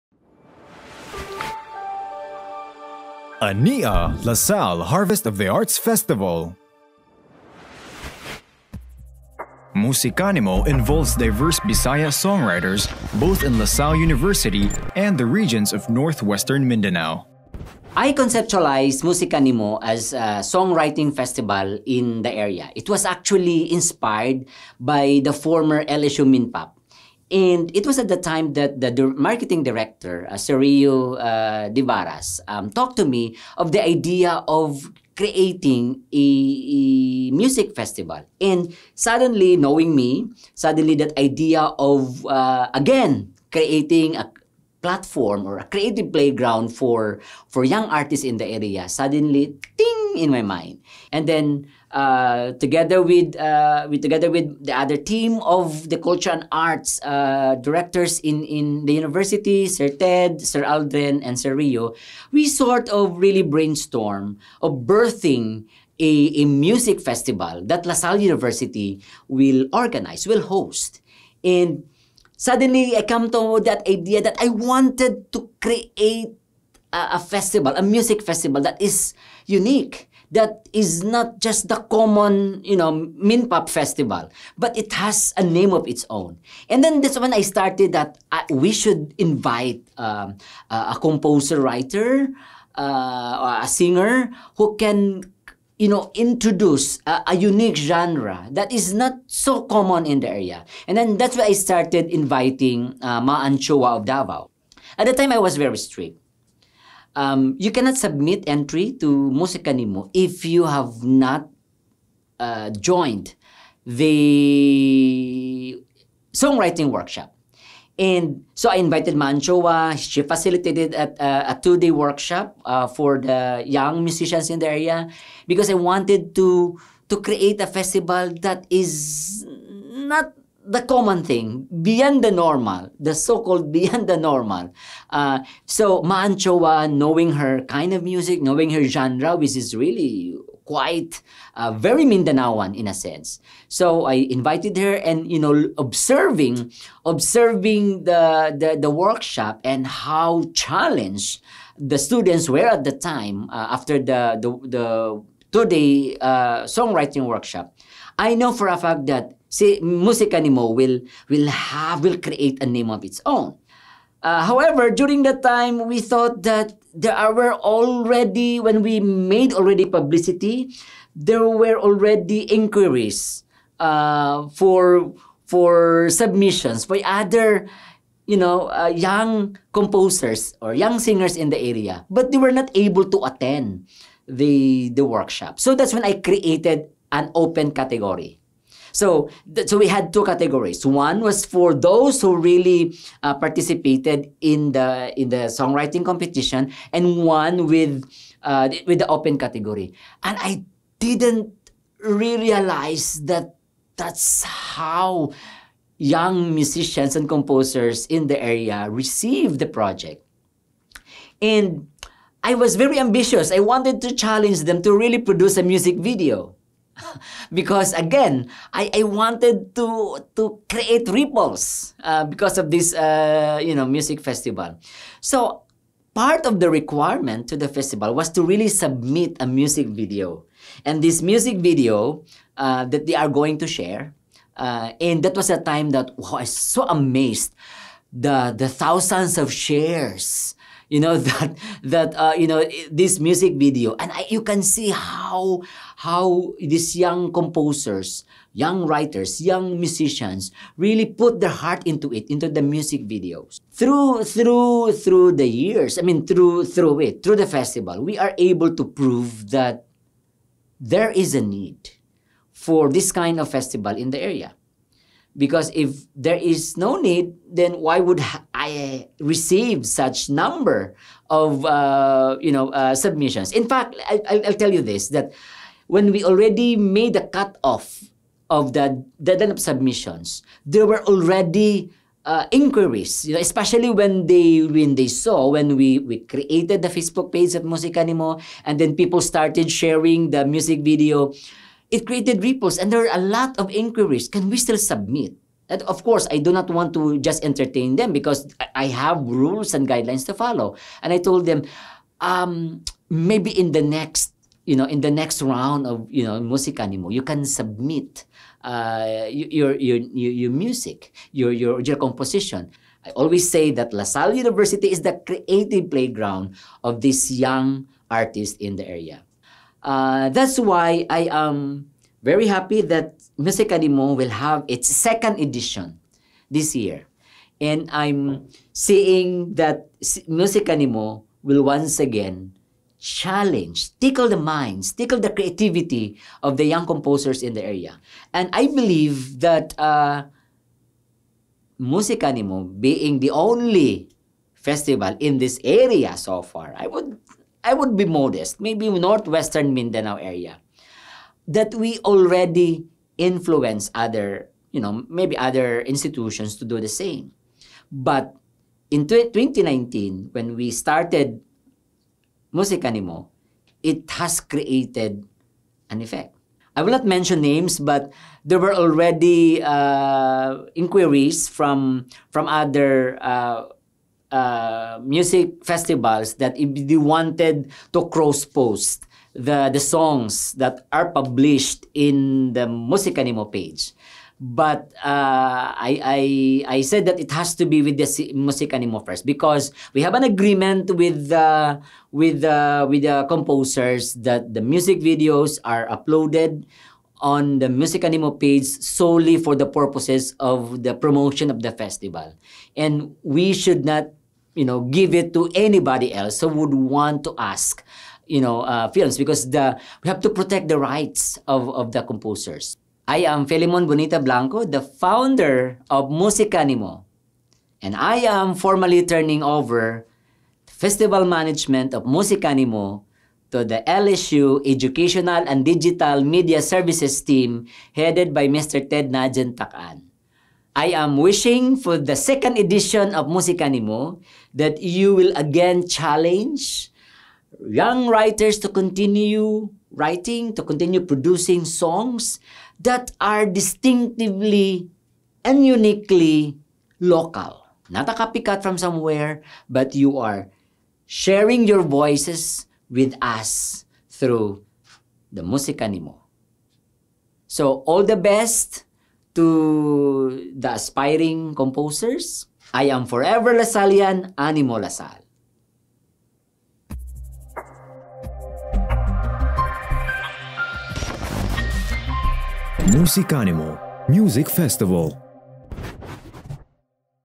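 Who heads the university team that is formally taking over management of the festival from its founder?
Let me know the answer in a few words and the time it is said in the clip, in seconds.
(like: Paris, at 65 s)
Ted Najan Takan, at 428 s.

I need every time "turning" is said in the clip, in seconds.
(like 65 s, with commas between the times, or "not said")
419 s.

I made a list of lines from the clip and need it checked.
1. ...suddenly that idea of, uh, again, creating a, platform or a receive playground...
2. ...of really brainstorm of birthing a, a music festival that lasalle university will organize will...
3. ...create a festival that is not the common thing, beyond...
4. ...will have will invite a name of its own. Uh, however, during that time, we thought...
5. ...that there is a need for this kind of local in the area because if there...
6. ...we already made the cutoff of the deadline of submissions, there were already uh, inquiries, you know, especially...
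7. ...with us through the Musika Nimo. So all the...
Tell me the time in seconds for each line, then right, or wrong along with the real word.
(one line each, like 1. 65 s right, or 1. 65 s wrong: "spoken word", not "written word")
1. 40 s wrong: "creative", not "receive"
2. 62 s right
3. 127 s right
4. 161 s wrong: "create", not "invite"
5. 259 s wrong: "festival", not "local"
6. 276 s right
7. 452 s right.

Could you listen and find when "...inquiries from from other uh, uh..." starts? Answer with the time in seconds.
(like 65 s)
370 s.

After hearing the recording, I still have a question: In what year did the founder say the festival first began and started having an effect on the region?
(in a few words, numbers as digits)
2019.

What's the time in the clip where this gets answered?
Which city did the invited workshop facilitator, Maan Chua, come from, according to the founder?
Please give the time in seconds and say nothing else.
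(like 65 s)
104 s.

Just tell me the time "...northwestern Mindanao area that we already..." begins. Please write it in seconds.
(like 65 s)
348 s.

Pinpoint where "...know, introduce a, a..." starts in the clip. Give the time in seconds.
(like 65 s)
95 s.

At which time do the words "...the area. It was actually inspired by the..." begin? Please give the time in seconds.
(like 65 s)
22 s.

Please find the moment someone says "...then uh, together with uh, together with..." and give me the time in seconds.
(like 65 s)
51 s.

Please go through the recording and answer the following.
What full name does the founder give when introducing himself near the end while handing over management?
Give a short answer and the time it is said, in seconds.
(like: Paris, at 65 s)
Felimon Bonita Blanco, at 413 s.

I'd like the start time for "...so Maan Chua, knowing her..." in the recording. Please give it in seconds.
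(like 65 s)
135 s.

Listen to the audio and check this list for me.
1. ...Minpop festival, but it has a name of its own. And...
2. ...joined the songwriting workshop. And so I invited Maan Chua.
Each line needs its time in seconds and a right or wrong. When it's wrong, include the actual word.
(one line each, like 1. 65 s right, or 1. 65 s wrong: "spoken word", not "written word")
1. 83 s right
2. 112 s right.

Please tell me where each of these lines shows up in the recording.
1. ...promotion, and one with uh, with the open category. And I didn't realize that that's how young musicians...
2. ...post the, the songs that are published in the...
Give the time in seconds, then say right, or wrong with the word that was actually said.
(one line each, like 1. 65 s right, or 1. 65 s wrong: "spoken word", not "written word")
1. 196 s wrong: "competition", not "promotion"
2. 378 s right.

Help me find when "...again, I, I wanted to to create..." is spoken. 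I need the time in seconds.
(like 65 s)
217 s.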